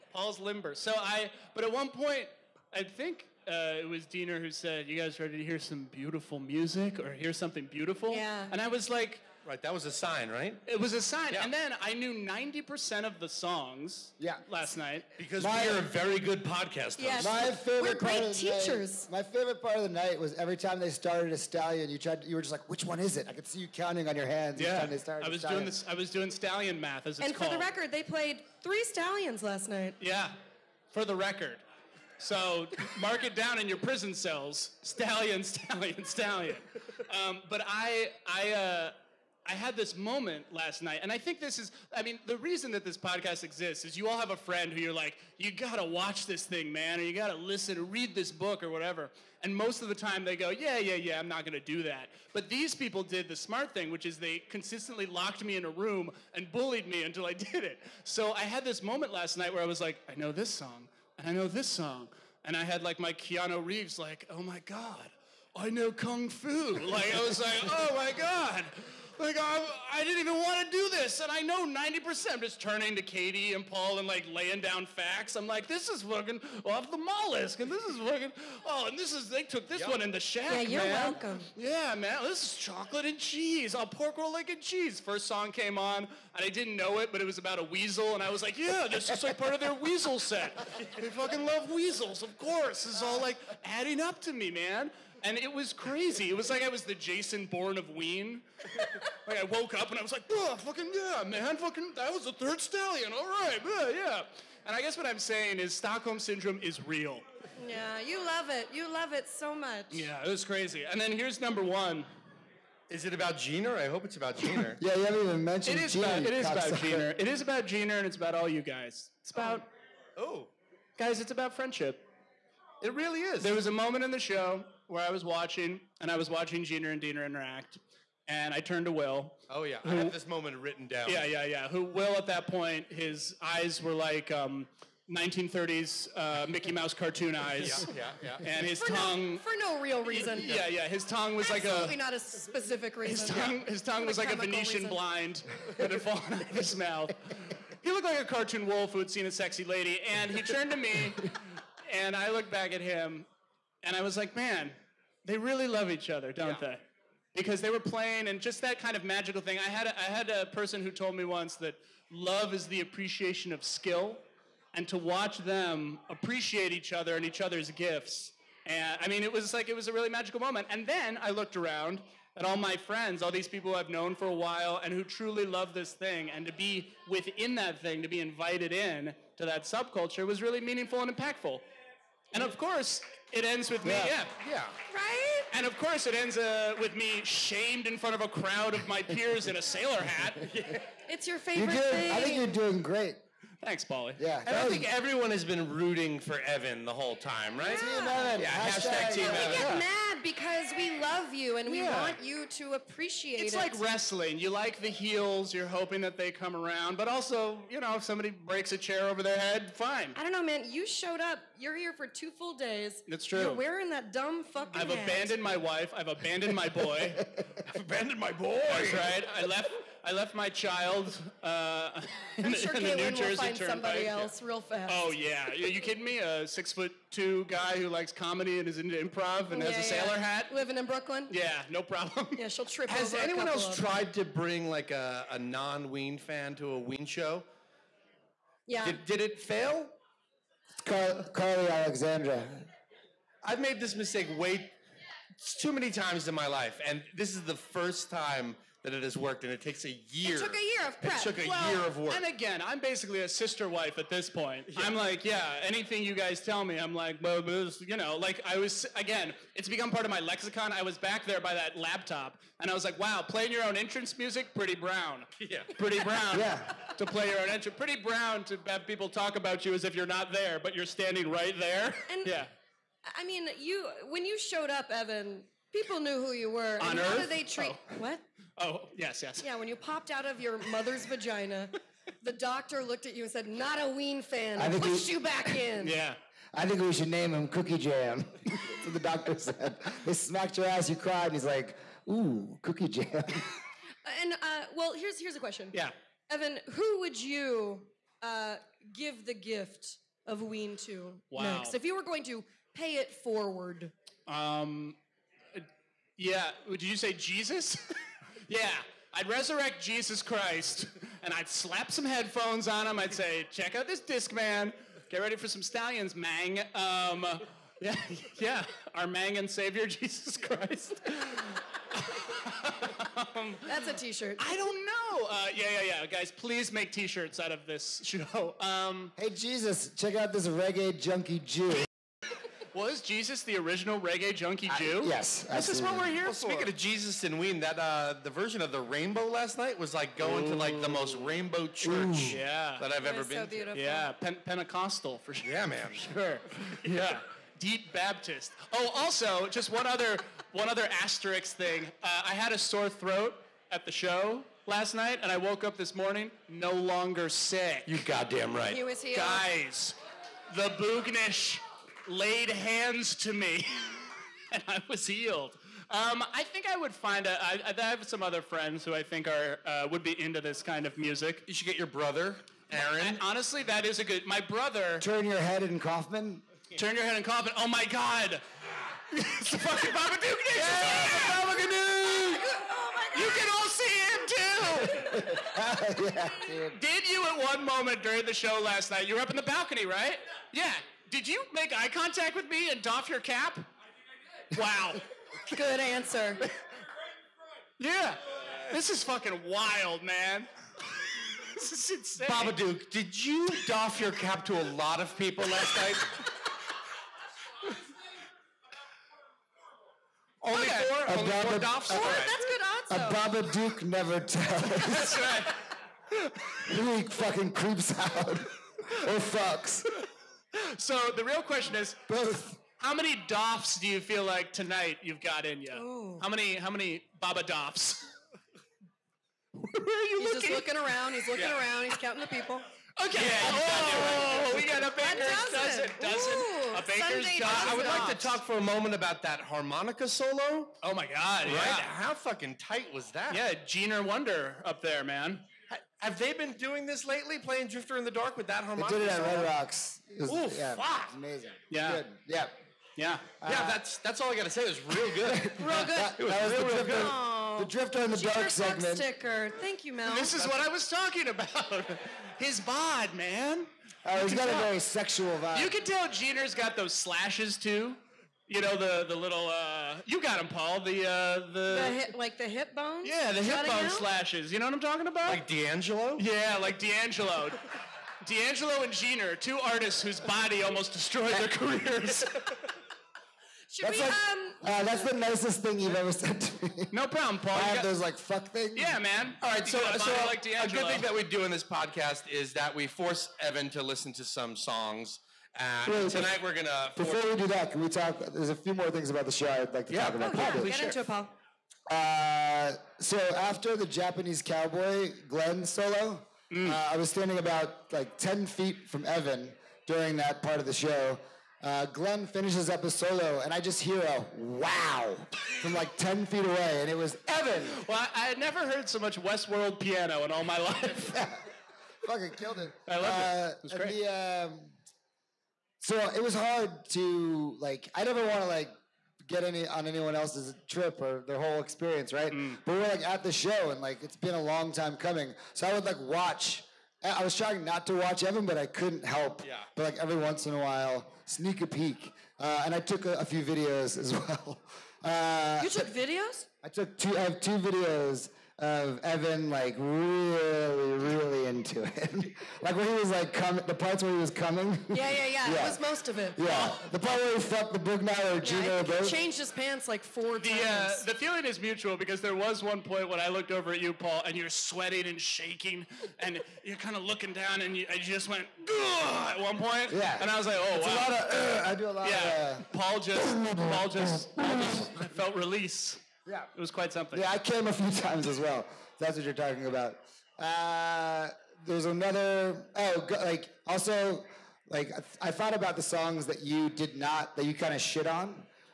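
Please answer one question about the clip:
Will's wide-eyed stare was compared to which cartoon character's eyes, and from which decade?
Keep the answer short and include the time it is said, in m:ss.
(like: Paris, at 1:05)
1930s Mickey Mouse, at 2:15.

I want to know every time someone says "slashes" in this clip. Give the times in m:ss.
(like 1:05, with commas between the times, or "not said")
7:46, 7:53.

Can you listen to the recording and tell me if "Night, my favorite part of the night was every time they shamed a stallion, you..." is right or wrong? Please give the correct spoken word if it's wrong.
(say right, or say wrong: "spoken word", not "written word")
wrong: "started", not "shamed".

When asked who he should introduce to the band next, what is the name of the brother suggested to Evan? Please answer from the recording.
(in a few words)
Aaron.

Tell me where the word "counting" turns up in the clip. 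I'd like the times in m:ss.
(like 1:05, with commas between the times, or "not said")
0:23, 7:11.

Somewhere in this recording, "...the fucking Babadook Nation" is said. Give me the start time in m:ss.
6:19.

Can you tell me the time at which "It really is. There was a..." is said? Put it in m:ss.
2:02.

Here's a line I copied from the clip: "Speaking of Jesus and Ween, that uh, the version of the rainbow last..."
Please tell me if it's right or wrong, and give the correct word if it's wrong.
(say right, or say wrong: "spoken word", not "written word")
right.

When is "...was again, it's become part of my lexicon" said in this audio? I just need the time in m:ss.
4:18.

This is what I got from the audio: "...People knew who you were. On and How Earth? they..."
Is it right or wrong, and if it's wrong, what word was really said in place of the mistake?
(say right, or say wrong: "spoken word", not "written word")
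right.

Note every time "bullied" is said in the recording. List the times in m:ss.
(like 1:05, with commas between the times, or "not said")
0:56.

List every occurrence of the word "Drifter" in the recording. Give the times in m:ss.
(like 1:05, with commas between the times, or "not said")
7:27, 7:37.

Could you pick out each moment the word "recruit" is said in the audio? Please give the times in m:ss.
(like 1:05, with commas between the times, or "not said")
not said.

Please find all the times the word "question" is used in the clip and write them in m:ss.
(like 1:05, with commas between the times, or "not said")
4:55, 7:01.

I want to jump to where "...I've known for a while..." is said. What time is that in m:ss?
2:53.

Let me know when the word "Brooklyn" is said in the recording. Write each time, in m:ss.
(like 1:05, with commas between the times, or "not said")
3:50.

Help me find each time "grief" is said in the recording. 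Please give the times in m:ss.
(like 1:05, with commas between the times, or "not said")
not said.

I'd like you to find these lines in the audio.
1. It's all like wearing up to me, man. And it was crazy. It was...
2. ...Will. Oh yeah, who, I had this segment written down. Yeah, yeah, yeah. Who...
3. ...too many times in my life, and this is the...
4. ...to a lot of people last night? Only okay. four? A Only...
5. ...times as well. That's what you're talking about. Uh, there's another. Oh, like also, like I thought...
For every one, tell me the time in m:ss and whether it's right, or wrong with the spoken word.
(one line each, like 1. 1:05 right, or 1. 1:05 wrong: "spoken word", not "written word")
1. 1:32 wrong: "adding", not "wearing"
2. 2:08 wrong: "moment", not "segment"
3. 4:05 right
4. 6:44 right
5. 9:38 right.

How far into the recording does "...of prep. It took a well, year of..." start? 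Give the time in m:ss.
4:10.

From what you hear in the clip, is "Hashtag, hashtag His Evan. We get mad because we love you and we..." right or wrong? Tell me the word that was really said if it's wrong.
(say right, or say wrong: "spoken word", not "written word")
wrong: "Team", not "His".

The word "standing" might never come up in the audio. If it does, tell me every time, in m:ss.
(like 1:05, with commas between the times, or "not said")
4:30, 8:27.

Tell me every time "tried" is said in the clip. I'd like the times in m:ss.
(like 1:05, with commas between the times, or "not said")
0:21, 3:53.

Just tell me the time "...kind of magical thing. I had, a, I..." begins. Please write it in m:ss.
2:38.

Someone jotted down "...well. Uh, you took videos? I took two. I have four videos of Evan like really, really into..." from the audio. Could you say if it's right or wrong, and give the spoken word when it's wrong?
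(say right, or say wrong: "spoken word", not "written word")
wrong: "two", not "four".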